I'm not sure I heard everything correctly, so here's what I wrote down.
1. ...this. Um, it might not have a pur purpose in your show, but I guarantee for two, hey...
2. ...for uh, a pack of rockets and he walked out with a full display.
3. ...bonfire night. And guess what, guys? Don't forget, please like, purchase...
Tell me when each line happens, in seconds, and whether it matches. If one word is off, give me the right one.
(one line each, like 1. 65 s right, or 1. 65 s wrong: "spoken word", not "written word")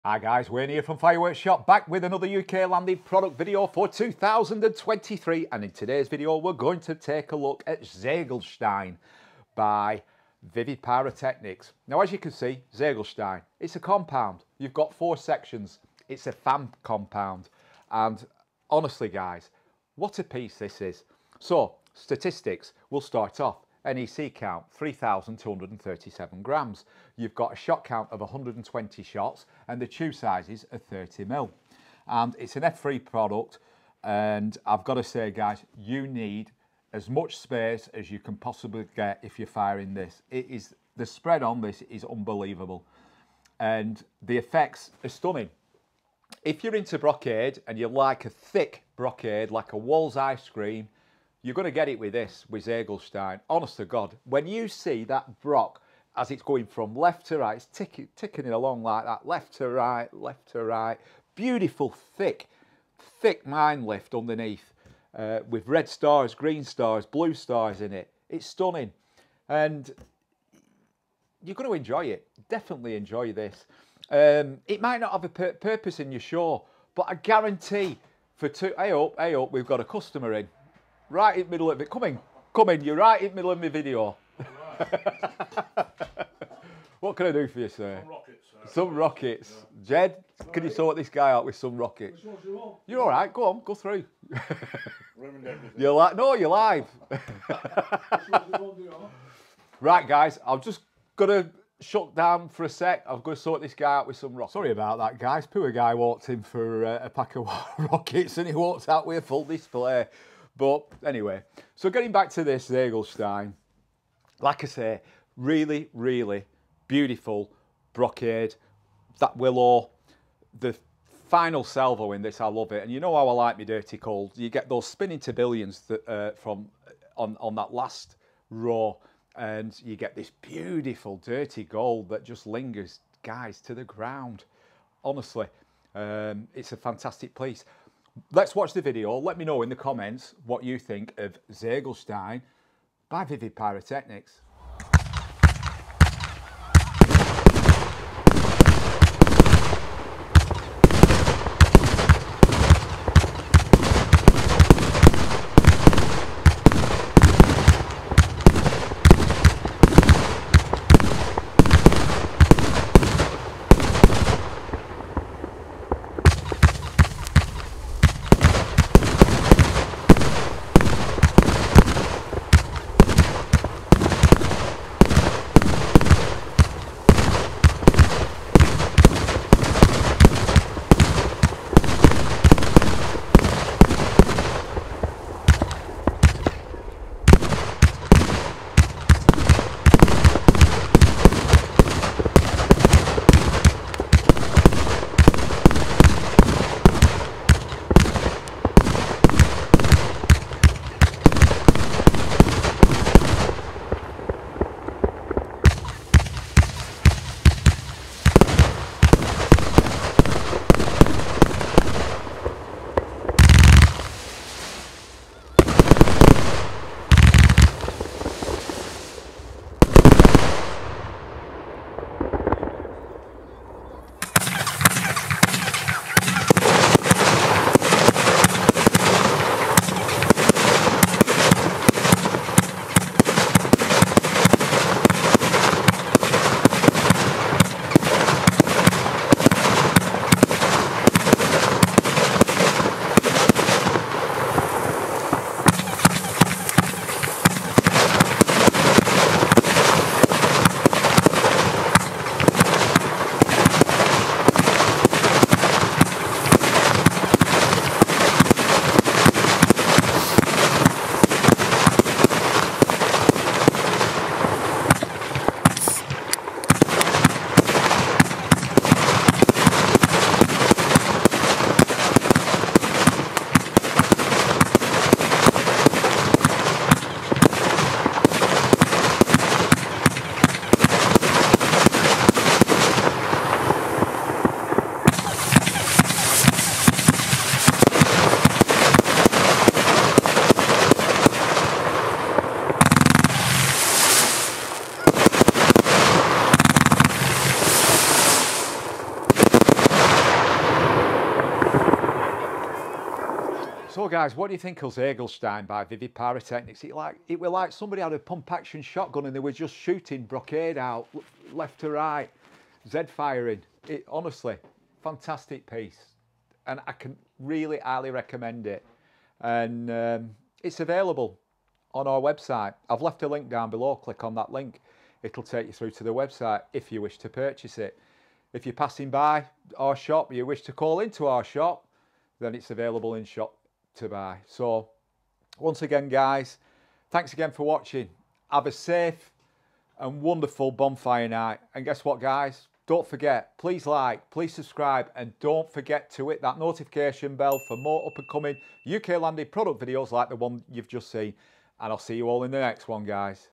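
1. 73 s right
2. 106 s right
3. 340 s wrong: "please", not "purchase".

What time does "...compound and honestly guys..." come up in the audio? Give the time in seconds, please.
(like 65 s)
16 s.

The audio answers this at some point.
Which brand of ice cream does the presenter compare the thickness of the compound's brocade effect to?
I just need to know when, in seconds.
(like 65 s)
49 s.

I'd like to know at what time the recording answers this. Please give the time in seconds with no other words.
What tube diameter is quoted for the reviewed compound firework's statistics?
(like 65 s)
30 s.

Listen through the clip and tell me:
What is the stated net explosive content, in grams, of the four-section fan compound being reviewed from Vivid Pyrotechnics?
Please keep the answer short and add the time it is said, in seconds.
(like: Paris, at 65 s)
3,237 grams, at 24 s.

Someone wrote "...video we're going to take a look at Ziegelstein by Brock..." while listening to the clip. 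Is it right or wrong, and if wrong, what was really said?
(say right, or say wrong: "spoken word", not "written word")
wrong: "Vivid", not "Brock".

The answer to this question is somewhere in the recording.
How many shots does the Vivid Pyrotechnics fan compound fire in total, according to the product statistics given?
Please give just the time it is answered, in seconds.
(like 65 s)
28 s.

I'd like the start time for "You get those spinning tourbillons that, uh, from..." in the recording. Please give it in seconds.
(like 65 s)
124 s.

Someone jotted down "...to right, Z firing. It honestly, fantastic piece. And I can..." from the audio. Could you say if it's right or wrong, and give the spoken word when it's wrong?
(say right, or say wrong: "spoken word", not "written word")
right.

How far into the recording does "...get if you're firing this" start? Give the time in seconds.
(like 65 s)
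38 s.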